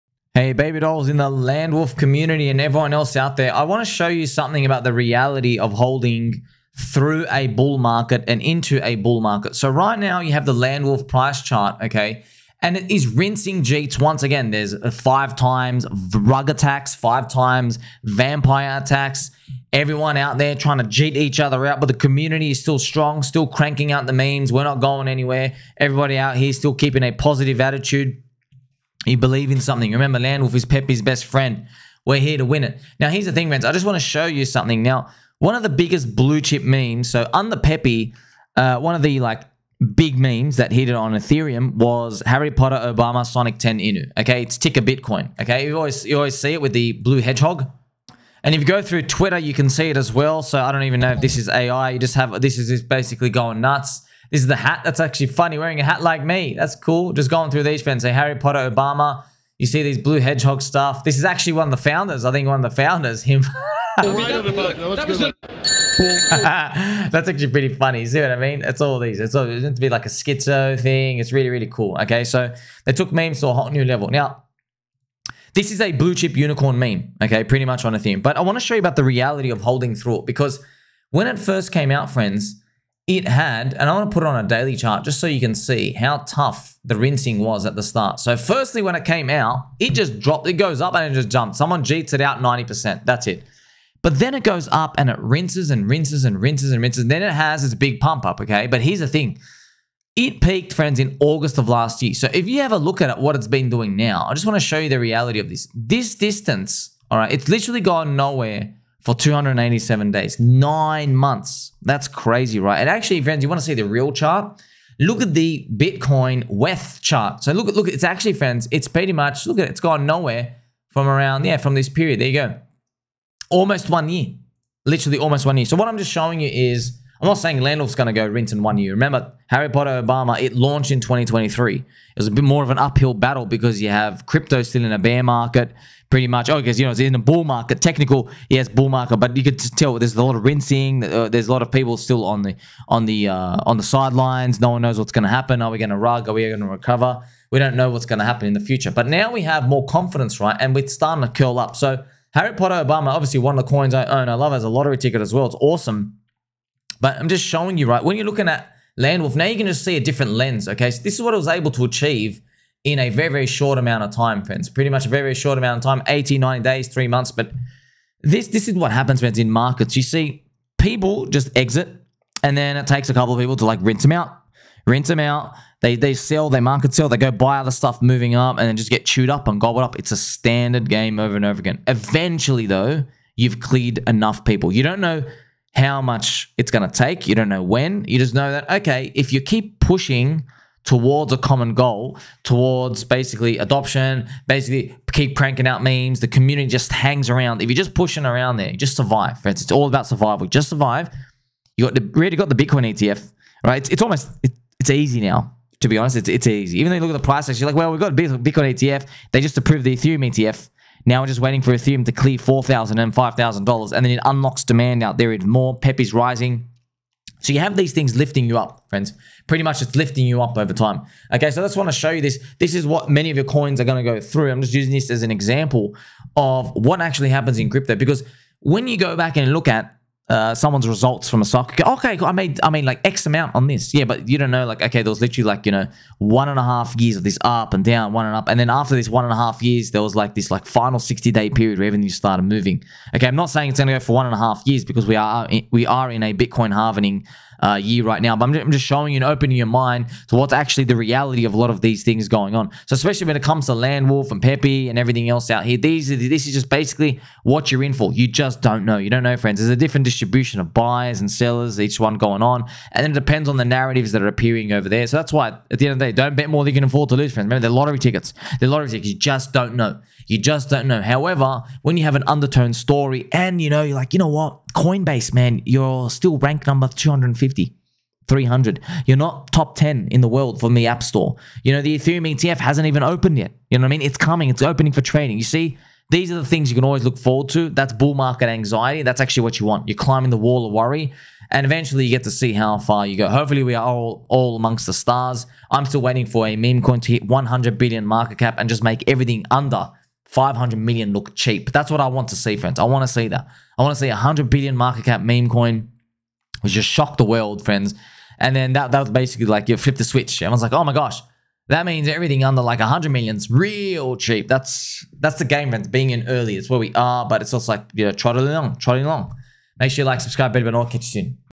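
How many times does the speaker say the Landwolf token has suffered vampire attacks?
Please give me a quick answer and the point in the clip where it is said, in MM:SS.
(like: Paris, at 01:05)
5, at 00:16.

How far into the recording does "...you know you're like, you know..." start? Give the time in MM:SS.
04:33.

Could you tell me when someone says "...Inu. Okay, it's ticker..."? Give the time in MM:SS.
00:43.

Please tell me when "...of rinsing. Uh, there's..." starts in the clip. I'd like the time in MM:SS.
02:20.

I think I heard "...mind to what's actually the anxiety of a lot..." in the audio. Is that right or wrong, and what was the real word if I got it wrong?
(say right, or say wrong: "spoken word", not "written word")
wrong: "reality", not "anxiety".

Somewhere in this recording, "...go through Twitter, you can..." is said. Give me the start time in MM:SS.
00:48.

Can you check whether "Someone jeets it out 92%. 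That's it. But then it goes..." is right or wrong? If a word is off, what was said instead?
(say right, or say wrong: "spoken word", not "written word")
wrong: "90", not "92".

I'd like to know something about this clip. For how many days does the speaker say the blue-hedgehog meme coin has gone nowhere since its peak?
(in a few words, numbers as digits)
287.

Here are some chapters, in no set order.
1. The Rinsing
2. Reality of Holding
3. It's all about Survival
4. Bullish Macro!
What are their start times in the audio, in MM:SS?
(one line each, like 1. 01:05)
1. 01:25
2. 02:00
3. 03:00
4. 03:25.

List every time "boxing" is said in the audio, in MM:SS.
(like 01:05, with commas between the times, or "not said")
not said.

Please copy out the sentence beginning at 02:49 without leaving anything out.
You see people just exit and then it takes a couple of people to like rinse them out, rinse them out.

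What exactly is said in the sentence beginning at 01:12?
Okay, so they took memes to a hot new level.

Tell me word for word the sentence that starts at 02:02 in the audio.
There you go, almost one year, literally almost one year.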